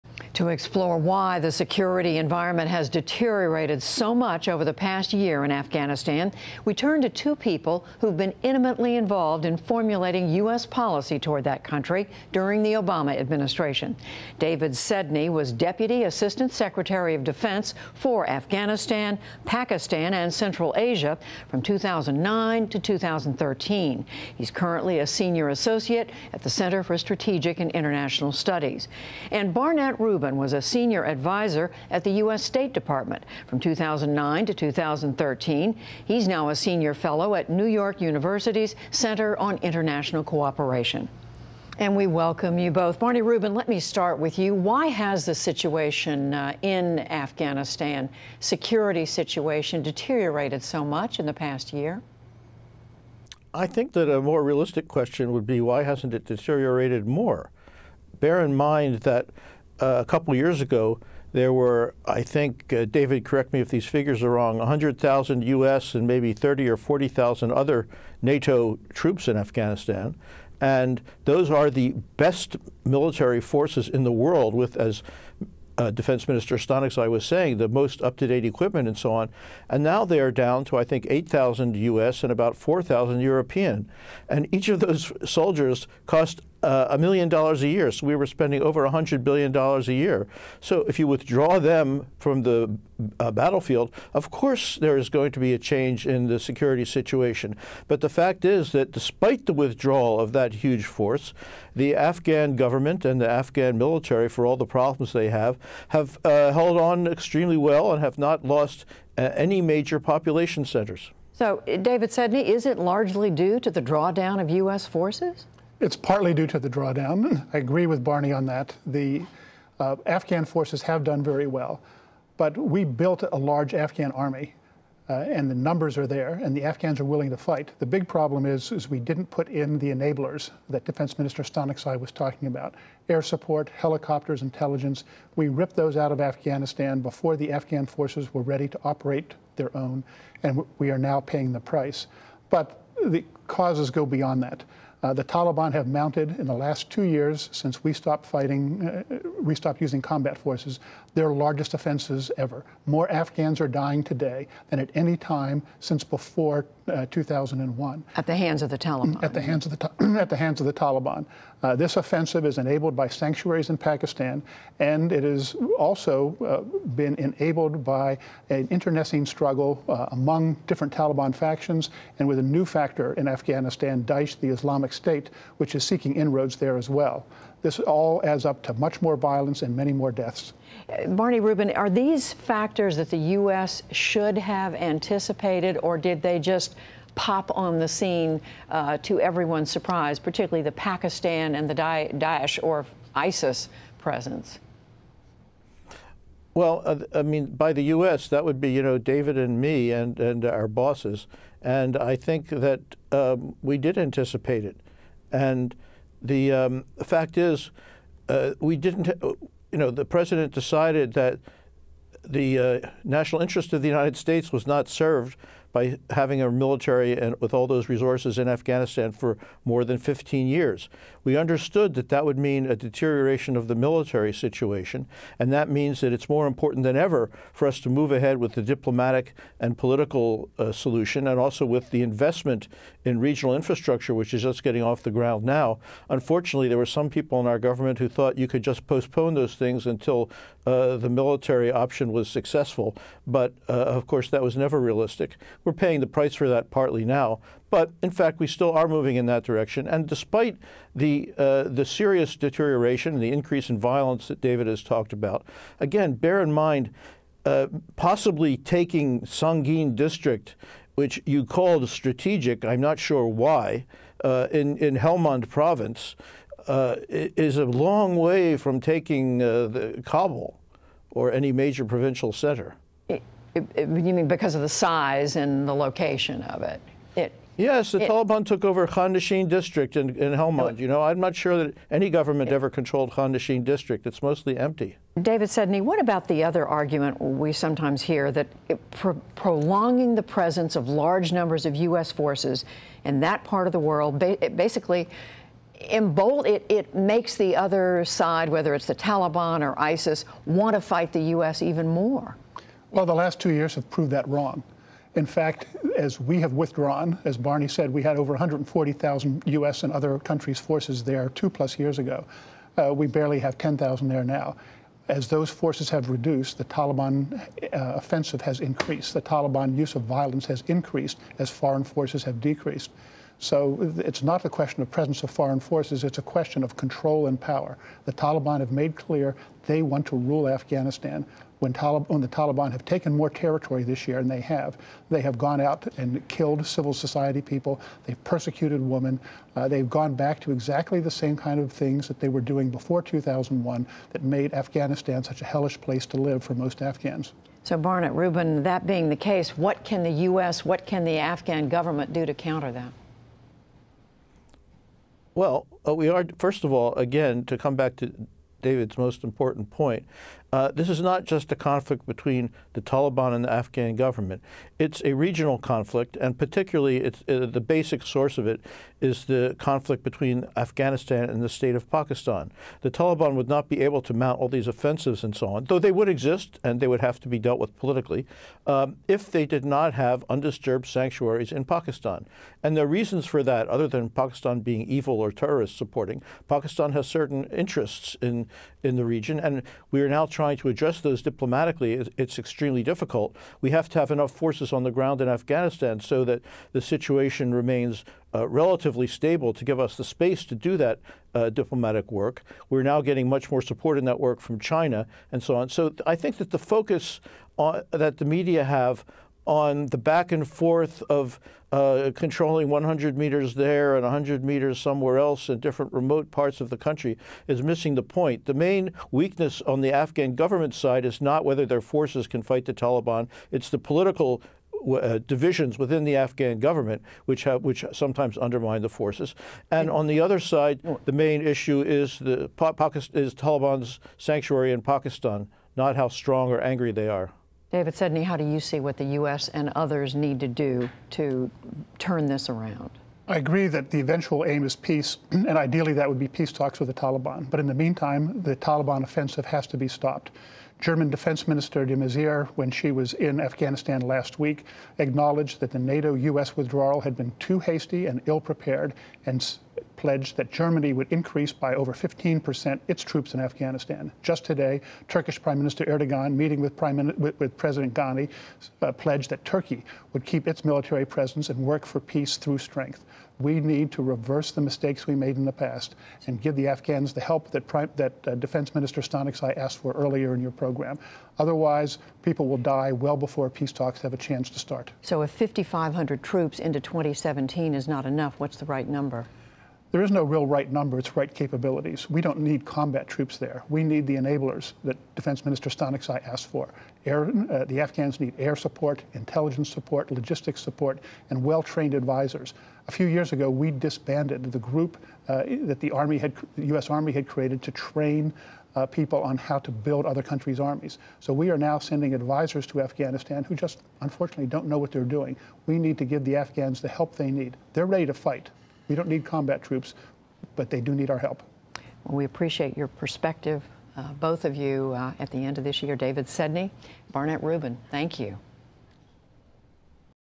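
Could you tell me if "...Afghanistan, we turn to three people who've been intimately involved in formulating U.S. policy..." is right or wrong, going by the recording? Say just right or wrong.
wrong.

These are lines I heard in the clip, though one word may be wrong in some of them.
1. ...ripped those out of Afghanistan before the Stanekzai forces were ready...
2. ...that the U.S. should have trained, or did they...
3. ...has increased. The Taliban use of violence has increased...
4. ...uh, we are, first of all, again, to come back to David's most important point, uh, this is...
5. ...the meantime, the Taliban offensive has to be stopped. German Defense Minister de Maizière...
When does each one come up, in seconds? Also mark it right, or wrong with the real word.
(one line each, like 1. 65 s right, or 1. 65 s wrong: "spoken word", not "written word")
1. 135 s wrong: "Afghan", not "Stanekzai"
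2. 182 s wrong: "anticipated", not "trained"
3. 318 s right
4. 355 s right
5. 447 s right.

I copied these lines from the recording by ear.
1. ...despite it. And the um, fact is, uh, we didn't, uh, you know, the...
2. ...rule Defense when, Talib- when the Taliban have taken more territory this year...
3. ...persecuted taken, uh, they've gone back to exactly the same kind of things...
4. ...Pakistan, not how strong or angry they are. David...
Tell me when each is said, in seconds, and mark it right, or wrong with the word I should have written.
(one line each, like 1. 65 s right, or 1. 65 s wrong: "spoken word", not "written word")
1. 203 s wrong: "anticipate", not "despite"
2. 330 s wrong: "Afghanistan", not "Defense"
3. 338 s wrong: "women", not "taken"
4. 434 s right.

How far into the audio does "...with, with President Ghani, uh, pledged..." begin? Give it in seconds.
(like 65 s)
467 s.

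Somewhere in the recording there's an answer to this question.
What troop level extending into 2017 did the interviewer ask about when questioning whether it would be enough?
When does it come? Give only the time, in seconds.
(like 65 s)
485 s.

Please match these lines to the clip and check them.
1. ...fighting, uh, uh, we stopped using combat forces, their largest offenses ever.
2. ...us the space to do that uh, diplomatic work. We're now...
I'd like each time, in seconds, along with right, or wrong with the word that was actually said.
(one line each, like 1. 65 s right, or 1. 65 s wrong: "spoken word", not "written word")
1. 148 s right
2. 399 s right.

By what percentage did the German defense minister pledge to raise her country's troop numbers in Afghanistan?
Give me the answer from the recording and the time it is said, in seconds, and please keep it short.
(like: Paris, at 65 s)
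over 15%, at 461 s.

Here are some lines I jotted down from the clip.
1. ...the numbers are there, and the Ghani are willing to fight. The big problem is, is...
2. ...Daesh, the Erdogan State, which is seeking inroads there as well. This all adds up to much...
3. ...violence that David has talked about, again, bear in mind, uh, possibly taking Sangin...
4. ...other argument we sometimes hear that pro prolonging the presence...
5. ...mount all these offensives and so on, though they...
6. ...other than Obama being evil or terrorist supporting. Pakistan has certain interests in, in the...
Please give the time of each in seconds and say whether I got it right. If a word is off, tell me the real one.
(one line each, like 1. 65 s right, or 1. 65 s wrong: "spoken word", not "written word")
1. 125 s wrong: "Afghans", not "Ghani"
2. 174 s wrong: "Islamic", not "Erdogan"
3. 253 s right
4. 286 s right
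5. 374 s right
6. 383 s wrong: "Pakistan", not "Obama".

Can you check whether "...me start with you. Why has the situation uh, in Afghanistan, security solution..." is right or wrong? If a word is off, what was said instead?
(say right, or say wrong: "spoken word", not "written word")
wrong: "situation", not "solution".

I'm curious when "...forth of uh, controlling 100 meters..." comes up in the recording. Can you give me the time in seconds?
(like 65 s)
410 s.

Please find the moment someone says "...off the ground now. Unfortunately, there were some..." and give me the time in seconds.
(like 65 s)
234 s.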